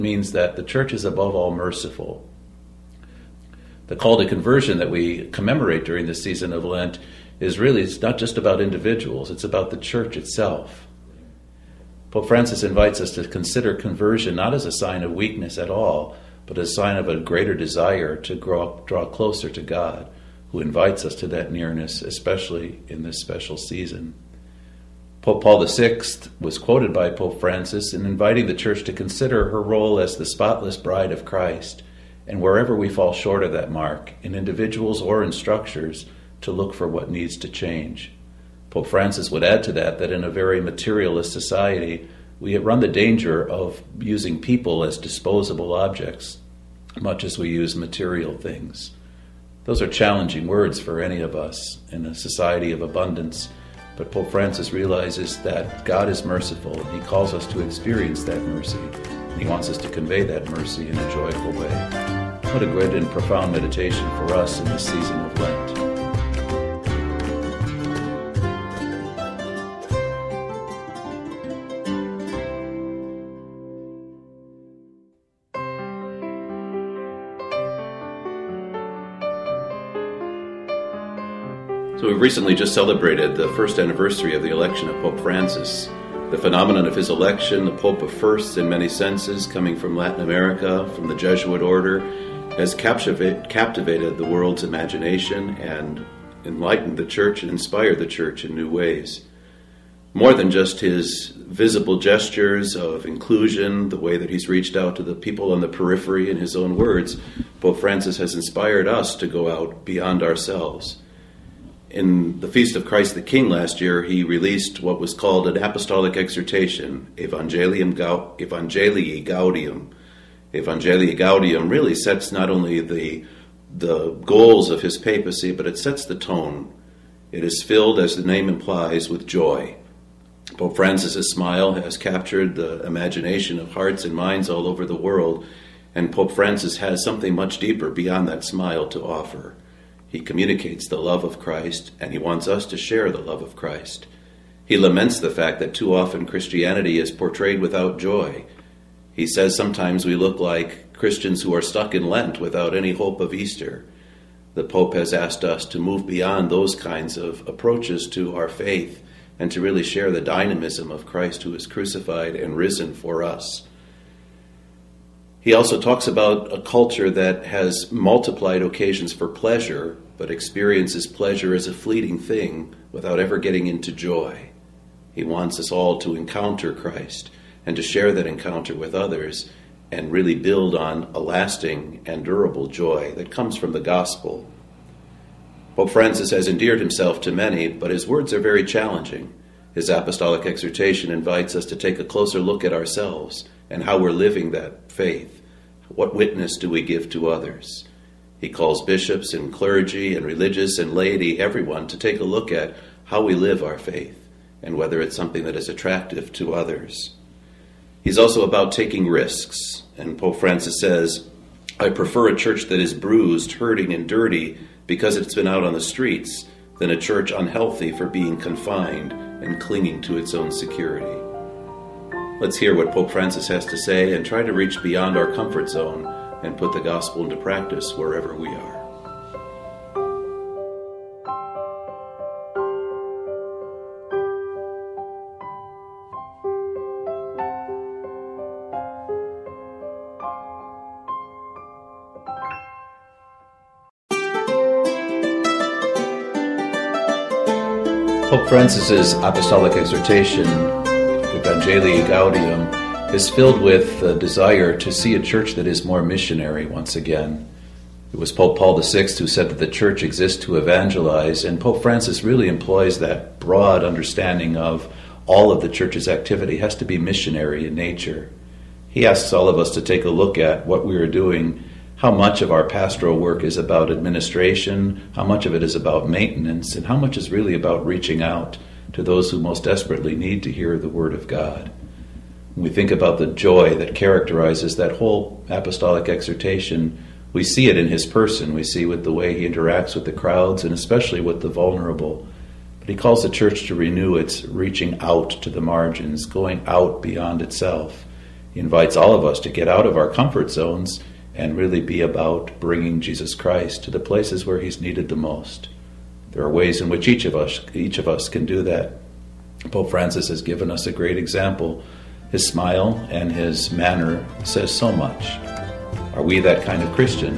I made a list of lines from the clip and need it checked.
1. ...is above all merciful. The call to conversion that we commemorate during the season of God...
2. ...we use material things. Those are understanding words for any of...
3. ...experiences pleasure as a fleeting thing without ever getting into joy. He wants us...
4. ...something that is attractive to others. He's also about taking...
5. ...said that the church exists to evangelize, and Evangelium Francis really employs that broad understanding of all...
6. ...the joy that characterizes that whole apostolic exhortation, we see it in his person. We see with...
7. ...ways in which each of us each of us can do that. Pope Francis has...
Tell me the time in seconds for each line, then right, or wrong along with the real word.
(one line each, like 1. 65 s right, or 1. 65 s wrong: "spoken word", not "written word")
1. 0 s wrong: "Lent", not "God"
2. 47 s wrong: "challenging", not "understanding"
3. 170 s right
4. 205 s right
5. 259 s wrong: "Pope", not "Evangelium"
6. 283 s right
7. 306 s right.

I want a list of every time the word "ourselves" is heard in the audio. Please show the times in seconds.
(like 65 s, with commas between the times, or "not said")
110 s, 192 s.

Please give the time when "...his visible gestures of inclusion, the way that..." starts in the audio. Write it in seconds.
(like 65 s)
100 s.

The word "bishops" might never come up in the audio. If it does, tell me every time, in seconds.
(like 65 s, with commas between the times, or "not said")
198 s.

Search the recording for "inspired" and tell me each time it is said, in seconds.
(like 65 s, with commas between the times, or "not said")
97 s, 108 s.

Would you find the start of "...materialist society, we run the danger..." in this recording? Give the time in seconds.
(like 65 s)
40 s.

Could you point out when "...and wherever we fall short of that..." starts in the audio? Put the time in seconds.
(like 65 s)
32 s.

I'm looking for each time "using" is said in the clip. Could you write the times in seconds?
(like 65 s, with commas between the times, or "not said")
43 s.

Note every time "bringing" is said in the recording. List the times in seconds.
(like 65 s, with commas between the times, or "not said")
302 s.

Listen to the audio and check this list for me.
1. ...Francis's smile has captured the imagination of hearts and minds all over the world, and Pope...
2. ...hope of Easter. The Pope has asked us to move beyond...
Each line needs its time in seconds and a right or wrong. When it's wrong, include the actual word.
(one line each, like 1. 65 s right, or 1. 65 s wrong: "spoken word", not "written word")
1. 130 s right
2. 152 s right.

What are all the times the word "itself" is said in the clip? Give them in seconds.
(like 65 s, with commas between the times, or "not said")
10 s, 297 s.